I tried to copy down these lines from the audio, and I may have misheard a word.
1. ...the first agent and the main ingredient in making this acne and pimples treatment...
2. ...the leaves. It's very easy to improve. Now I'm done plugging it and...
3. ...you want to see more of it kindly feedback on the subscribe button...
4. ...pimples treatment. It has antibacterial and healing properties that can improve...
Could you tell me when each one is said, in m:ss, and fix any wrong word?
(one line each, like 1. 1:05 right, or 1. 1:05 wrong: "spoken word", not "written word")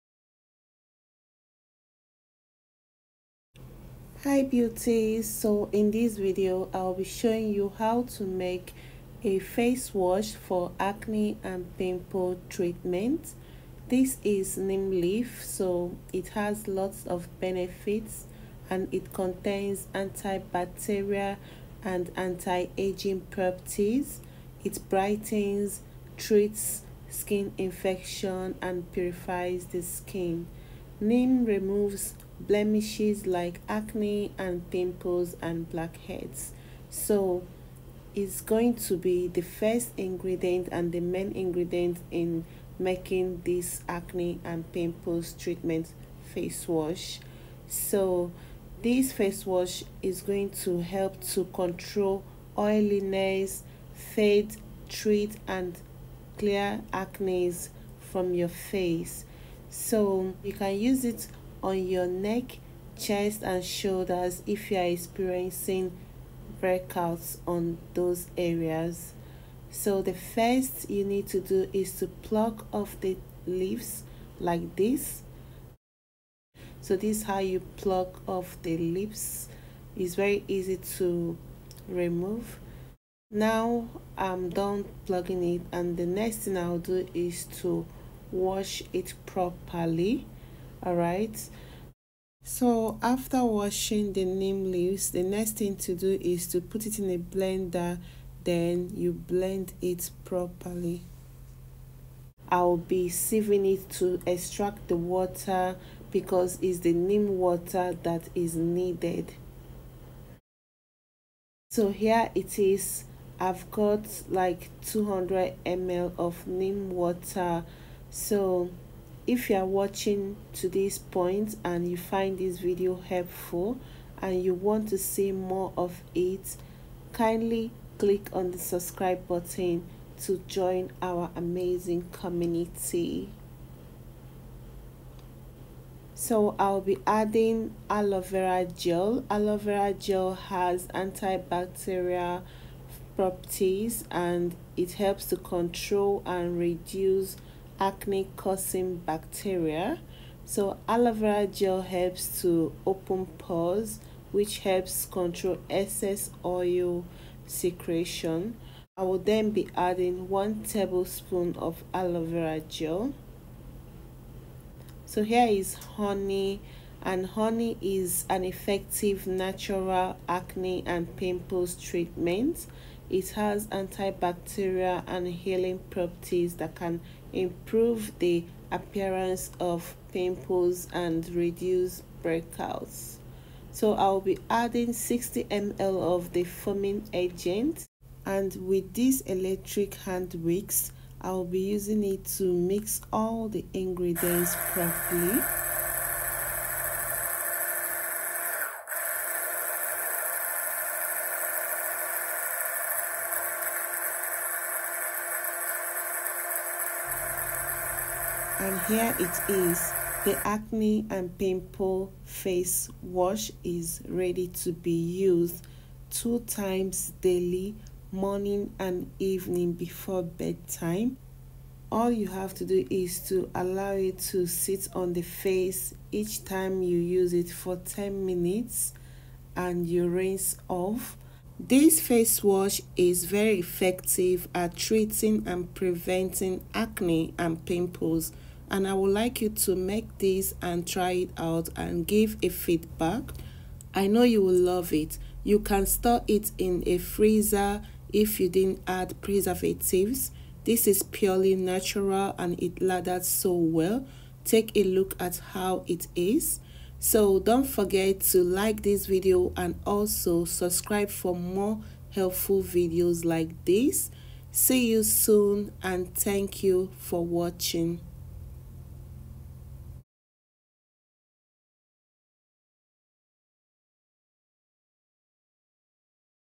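1. 0:39 wrong: "ingredient", not "agent"
2. 1:18 wrong: "remove", not "improve"
3. 2:04 wrong: "click", not "feedback"
4. 2:51 right.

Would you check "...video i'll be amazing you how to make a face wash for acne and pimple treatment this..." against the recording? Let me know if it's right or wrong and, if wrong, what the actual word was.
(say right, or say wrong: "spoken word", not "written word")
wrong: "showing", not "amazing".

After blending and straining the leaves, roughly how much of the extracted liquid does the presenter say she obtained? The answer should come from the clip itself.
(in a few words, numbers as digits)
200 ml.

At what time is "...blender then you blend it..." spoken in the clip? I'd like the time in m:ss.
1:37.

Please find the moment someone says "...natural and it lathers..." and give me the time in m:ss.
4:11.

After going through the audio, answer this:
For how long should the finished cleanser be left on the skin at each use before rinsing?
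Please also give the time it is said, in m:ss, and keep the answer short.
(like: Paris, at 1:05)
10 minutes, at 3:47.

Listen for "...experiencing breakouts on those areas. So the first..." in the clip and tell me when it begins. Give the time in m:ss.
1:04.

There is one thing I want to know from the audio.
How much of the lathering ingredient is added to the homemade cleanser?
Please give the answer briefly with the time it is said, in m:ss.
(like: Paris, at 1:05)
60 ml, at 3:04.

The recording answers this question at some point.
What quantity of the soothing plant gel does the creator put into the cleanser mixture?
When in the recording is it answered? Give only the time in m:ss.
2:40.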